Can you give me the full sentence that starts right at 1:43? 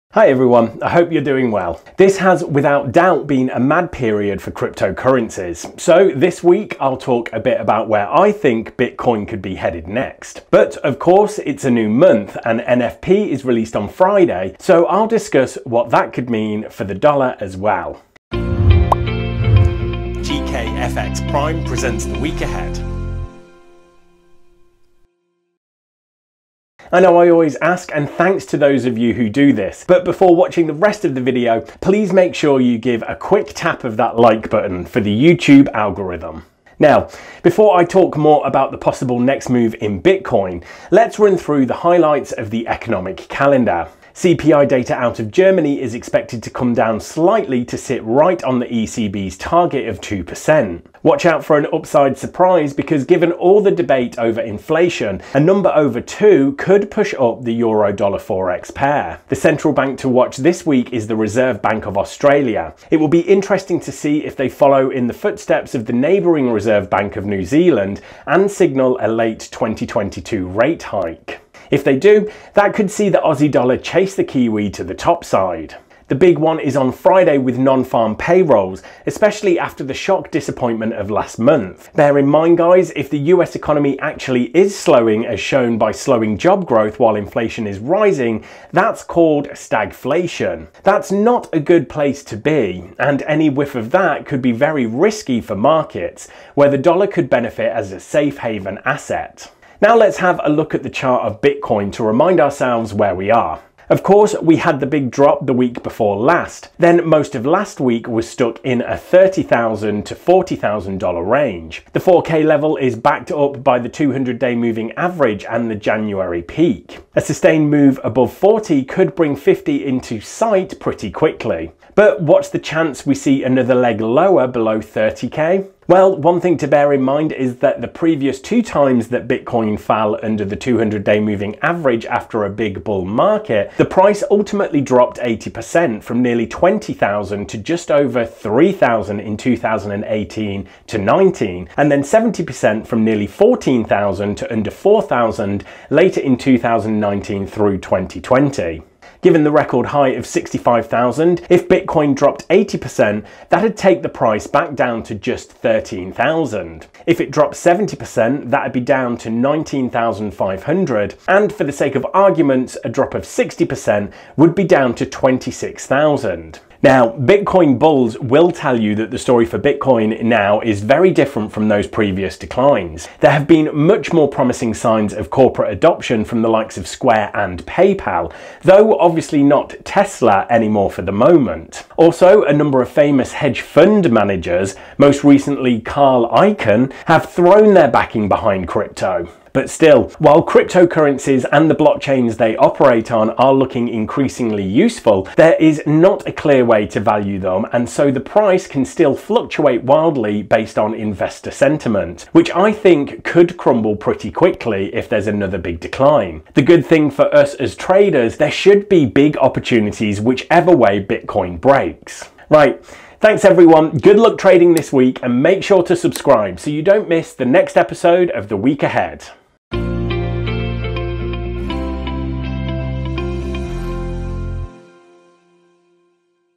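Of course, we had the big drop the week before last.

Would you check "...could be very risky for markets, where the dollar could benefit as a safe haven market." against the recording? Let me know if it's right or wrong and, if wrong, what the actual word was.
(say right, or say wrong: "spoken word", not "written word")
wrong: "asset", not "market".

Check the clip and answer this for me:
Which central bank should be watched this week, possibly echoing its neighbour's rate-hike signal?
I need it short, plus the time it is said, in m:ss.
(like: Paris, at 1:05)
Reserve Bank of Australia, at 1:01.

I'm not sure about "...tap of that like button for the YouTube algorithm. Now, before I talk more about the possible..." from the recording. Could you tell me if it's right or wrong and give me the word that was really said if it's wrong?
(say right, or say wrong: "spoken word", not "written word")
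right.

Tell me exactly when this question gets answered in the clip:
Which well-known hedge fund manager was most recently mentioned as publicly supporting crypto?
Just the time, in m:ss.
3:05.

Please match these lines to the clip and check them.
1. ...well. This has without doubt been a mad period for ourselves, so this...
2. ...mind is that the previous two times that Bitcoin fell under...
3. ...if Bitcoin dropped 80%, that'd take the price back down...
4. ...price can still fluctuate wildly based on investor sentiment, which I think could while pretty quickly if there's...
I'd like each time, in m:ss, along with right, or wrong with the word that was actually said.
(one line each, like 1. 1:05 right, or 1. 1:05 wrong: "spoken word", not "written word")
1. 0:01 wrong: "cryptocurrencies", not "ourselves"
2. 2:07 right
3. 2:31 right
4. 3:18 wrong: "crumble", not "while".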